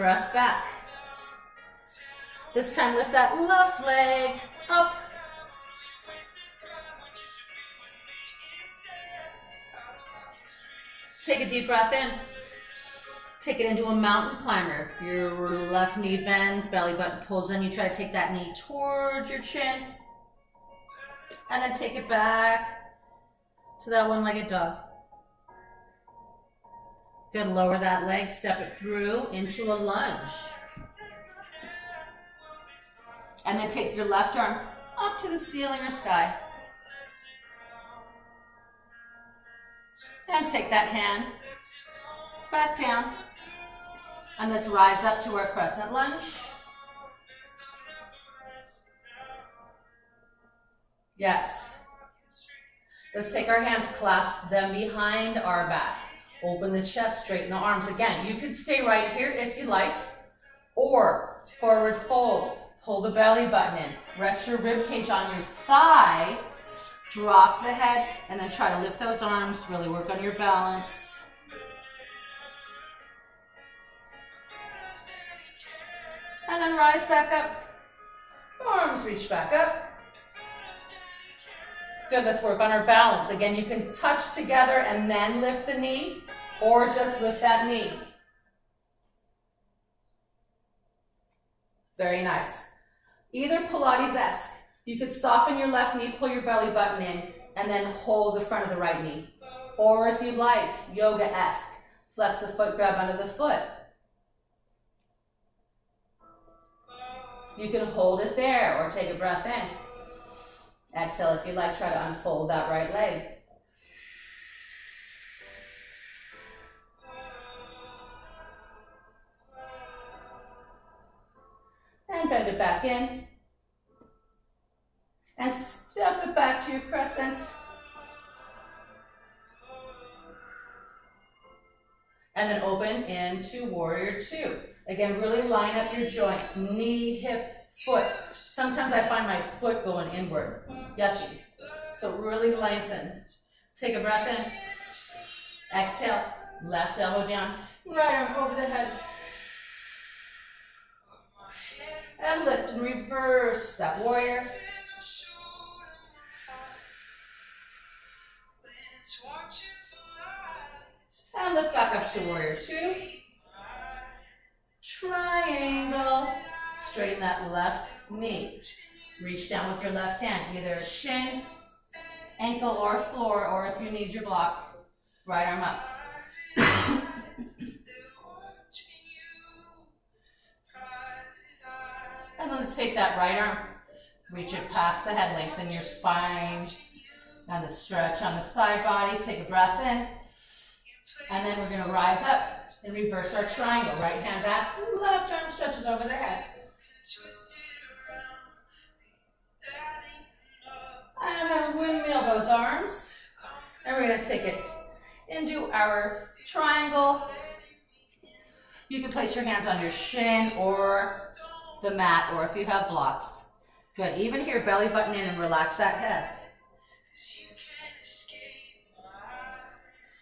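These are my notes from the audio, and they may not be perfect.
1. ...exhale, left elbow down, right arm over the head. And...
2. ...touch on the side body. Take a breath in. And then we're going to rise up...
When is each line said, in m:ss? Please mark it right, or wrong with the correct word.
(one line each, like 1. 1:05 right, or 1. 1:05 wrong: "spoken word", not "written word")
1. 2:25 right
2. 3:07 wrong: "stretch", not "touch".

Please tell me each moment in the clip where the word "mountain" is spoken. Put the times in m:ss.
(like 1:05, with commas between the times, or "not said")
0:13.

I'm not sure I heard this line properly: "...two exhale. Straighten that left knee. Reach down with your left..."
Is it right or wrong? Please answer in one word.
wrong.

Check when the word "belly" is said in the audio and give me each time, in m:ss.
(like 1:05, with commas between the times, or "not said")
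0:16, 1:03, 1:36, 3:34.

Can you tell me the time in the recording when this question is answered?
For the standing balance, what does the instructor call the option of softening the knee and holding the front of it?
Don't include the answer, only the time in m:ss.
1:33.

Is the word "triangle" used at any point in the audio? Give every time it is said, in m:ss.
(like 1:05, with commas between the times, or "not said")
2:44, 3:13, 3:26.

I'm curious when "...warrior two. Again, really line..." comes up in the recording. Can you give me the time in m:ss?
2:13.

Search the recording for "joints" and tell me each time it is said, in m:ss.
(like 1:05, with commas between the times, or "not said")
2:16.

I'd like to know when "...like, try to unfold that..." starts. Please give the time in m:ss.
1:51.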